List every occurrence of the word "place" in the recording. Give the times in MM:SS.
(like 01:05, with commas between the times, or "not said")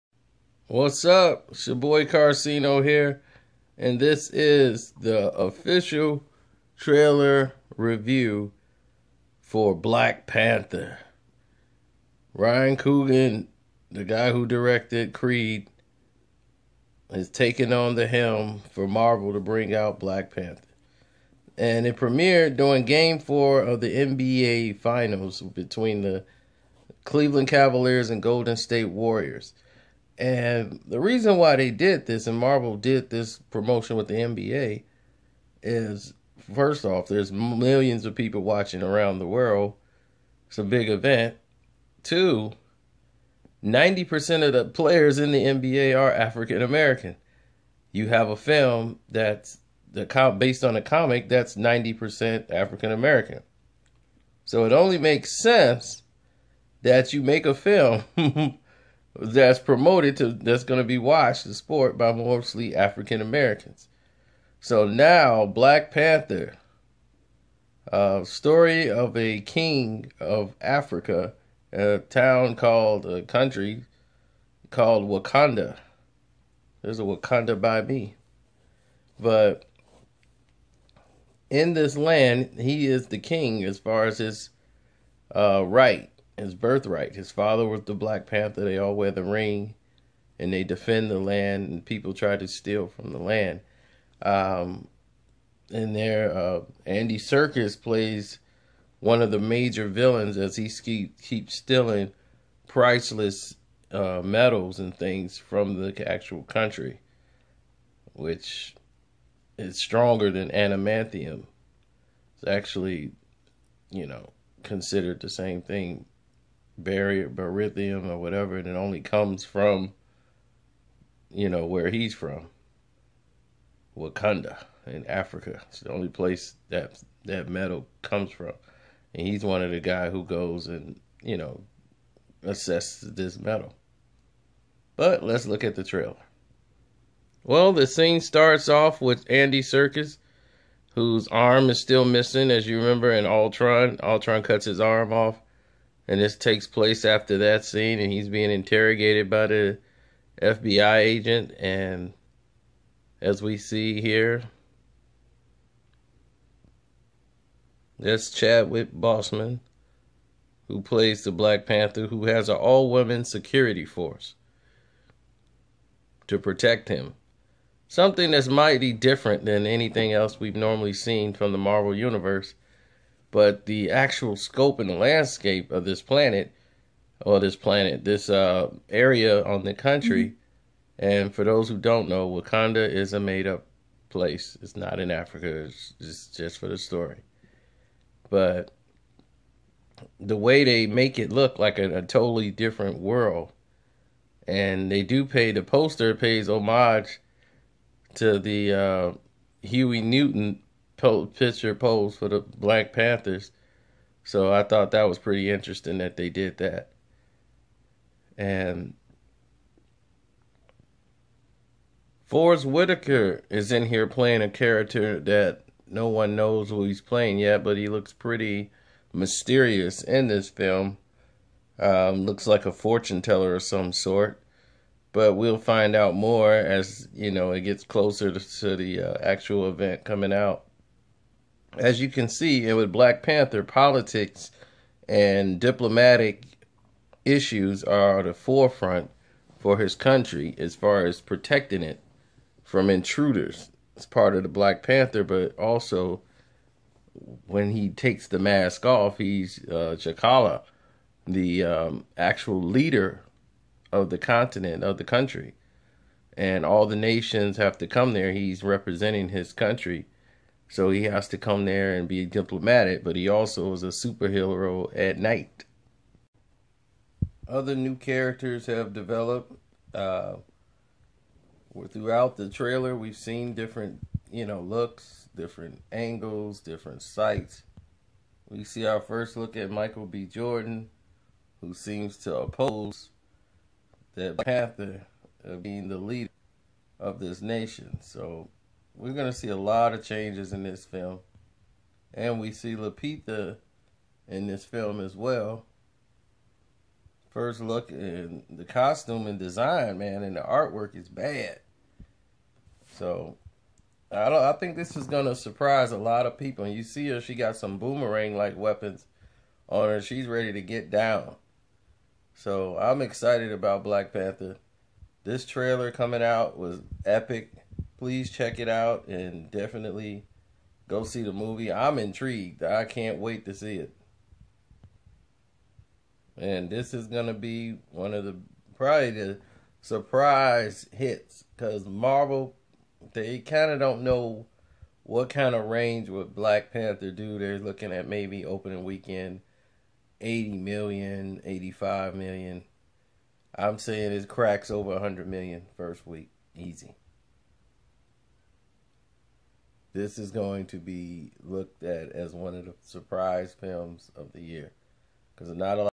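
02:06, 02:26, 03:04.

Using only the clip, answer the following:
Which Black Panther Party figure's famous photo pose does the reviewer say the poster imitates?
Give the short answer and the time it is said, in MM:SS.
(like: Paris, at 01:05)
Huey Newton, at 03:19.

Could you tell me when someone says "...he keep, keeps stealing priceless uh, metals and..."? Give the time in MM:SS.
01:40.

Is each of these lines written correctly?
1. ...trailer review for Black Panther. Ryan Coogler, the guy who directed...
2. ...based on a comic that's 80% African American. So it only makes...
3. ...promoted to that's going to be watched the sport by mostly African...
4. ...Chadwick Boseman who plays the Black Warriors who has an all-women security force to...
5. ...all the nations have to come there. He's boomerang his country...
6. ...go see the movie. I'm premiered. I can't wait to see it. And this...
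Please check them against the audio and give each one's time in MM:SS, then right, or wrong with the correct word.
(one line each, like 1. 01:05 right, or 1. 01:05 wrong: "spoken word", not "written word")
1. 00:06 right
2. 00:50 wrong: "90", not "80"
3. 00:59 right
4. 02:38 wrong: "Panther", not "Warriors"
5. 04:16 wrong: "representing", not "boomerang"
6. 05:20 wrong: "intrigued", not "premiered".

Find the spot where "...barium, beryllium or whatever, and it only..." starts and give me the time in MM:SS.
01:56.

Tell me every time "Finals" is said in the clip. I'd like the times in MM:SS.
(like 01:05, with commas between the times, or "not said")
00:24.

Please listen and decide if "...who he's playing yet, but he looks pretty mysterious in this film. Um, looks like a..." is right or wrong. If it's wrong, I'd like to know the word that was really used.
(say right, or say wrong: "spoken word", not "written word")
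right.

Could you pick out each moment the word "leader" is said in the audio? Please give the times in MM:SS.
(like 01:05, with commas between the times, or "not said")
04:12, 04:45.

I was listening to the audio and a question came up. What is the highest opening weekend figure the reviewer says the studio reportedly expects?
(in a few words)
85 million.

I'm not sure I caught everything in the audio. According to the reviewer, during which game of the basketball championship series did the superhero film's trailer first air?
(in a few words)
game 4.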